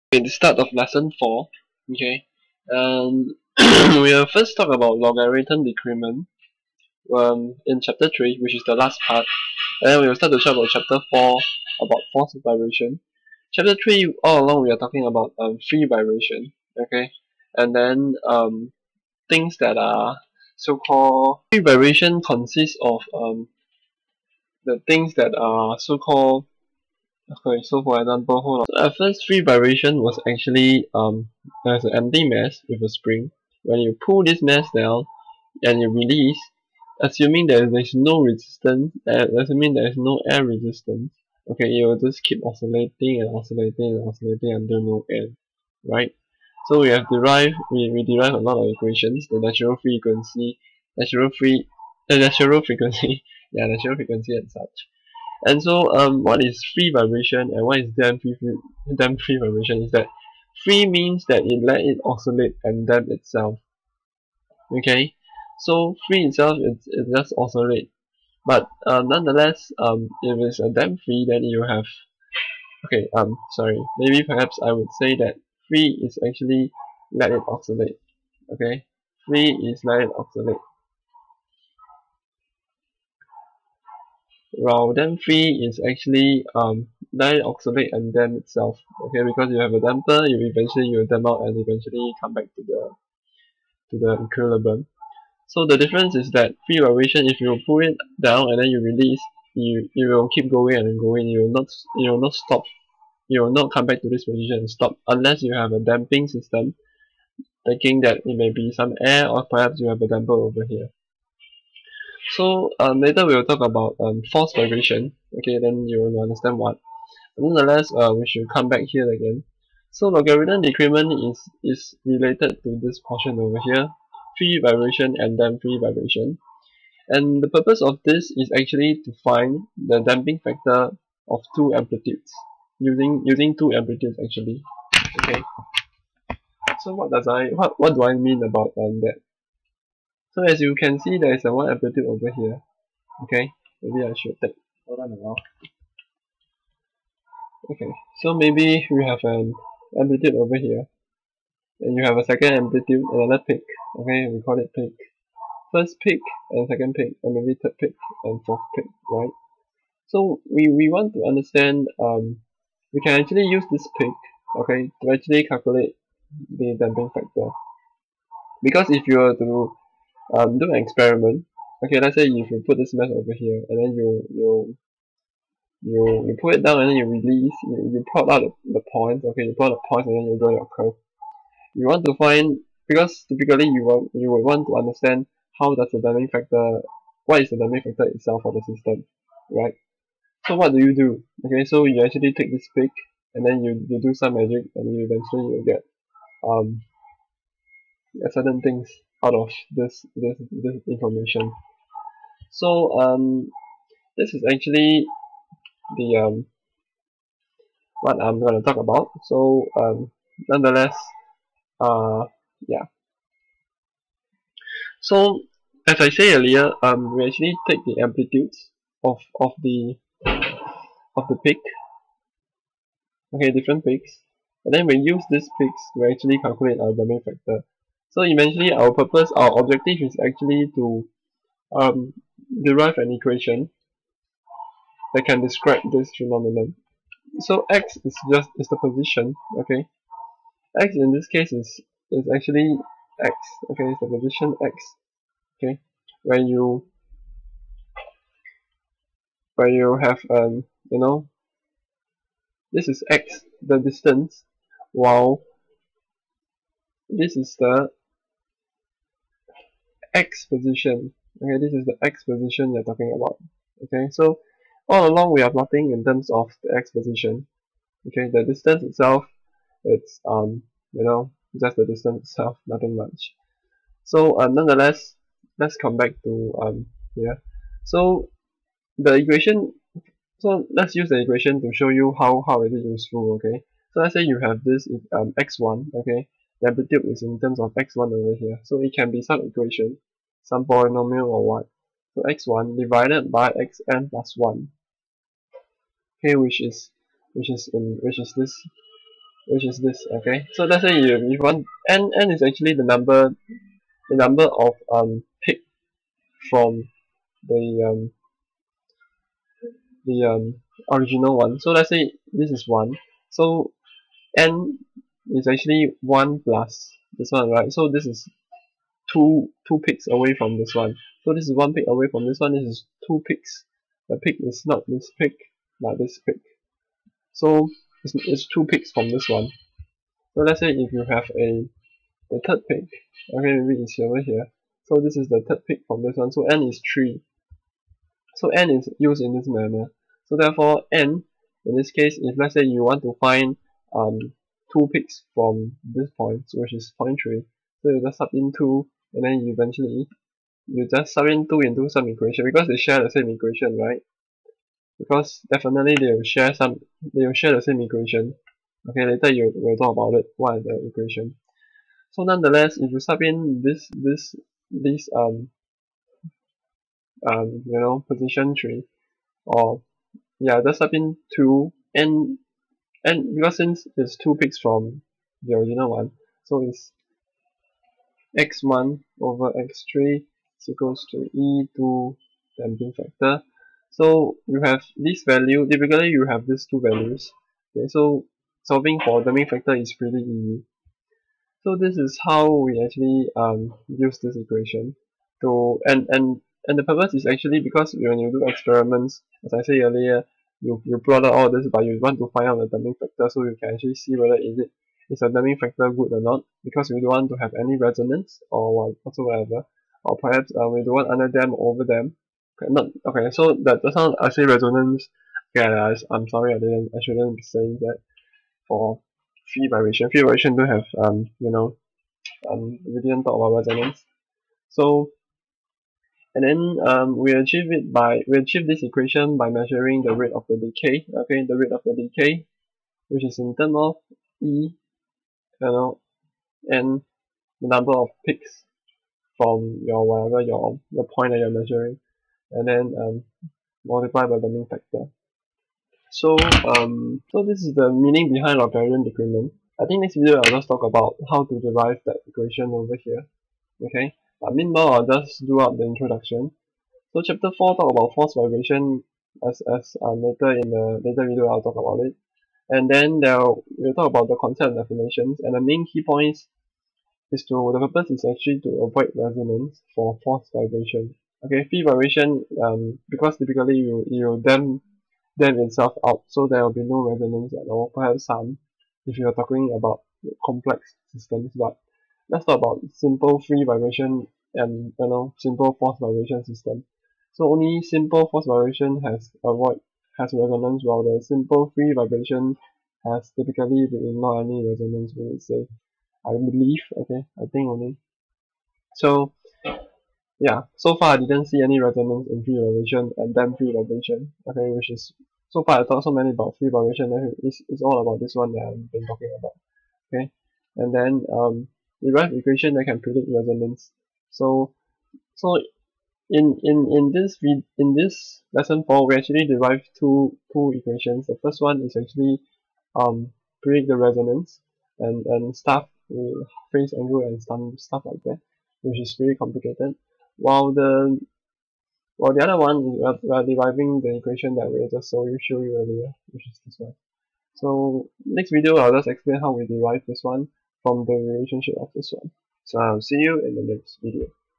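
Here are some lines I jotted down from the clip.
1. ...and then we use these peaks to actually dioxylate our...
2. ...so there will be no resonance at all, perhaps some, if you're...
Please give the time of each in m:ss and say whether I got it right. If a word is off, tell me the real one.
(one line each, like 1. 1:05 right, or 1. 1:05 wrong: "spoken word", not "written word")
1. 3:44 wrong: "calculate", not "dioxylate"
2. 7:56 right.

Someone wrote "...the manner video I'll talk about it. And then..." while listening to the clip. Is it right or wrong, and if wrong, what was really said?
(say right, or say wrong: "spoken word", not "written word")
wrong: "later", not "manner".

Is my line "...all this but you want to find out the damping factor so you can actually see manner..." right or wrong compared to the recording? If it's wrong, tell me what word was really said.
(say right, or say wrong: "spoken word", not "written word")
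wrong: "whether", not "manner".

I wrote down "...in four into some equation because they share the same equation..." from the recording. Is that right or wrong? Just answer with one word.
wrong.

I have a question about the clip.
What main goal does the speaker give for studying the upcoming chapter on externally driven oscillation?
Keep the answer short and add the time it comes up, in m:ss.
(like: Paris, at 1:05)
avoid resonance, at 7:48.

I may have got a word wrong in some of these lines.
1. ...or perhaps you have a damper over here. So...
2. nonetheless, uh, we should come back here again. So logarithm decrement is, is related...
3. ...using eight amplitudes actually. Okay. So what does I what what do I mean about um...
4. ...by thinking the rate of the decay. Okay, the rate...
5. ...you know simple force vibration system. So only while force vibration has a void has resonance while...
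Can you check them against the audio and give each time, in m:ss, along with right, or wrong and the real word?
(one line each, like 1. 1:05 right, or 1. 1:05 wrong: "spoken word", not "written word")
1. 1:49 right
2. 1:57 right
3. 2:13 wrong: "two", not "eight"
4. 7:09 wrong: "measuring", not "thinking"
5. 8:04 wrong: "simple", not "while".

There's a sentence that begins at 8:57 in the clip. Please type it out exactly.
So next video I'll just explain how we derive this one from the relationship of this one.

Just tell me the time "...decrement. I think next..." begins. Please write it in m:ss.
7:29.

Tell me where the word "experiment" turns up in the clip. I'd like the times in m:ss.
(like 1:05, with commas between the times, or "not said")
2:50, 6:38.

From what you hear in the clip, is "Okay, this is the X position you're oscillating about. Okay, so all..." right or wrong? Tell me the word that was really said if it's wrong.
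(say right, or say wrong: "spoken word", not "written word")
wrong: "talking", not "oscillating".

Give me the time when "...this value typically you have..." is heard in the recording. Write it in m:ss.
6:24.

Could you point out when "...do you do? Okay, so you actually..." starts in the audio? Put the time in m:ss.
3:10.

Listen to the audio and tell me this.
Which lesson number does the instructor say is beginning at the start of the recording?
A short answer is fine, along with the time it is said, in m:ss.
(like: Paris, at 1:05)
4, at 0:00.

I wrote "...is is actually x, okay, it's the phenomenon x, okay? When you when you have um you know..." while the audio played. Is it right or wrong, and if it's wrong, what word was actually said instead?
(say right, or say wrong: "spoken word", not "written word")
wrong: "position", not "phenomenon".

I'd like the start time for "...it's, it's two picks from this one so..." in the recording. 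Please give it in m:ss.
5:28.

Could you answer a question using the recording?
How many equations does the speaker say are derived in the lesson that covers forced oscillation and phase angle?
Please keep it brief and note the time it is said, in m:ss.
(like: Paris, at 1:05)
2, at 8:39.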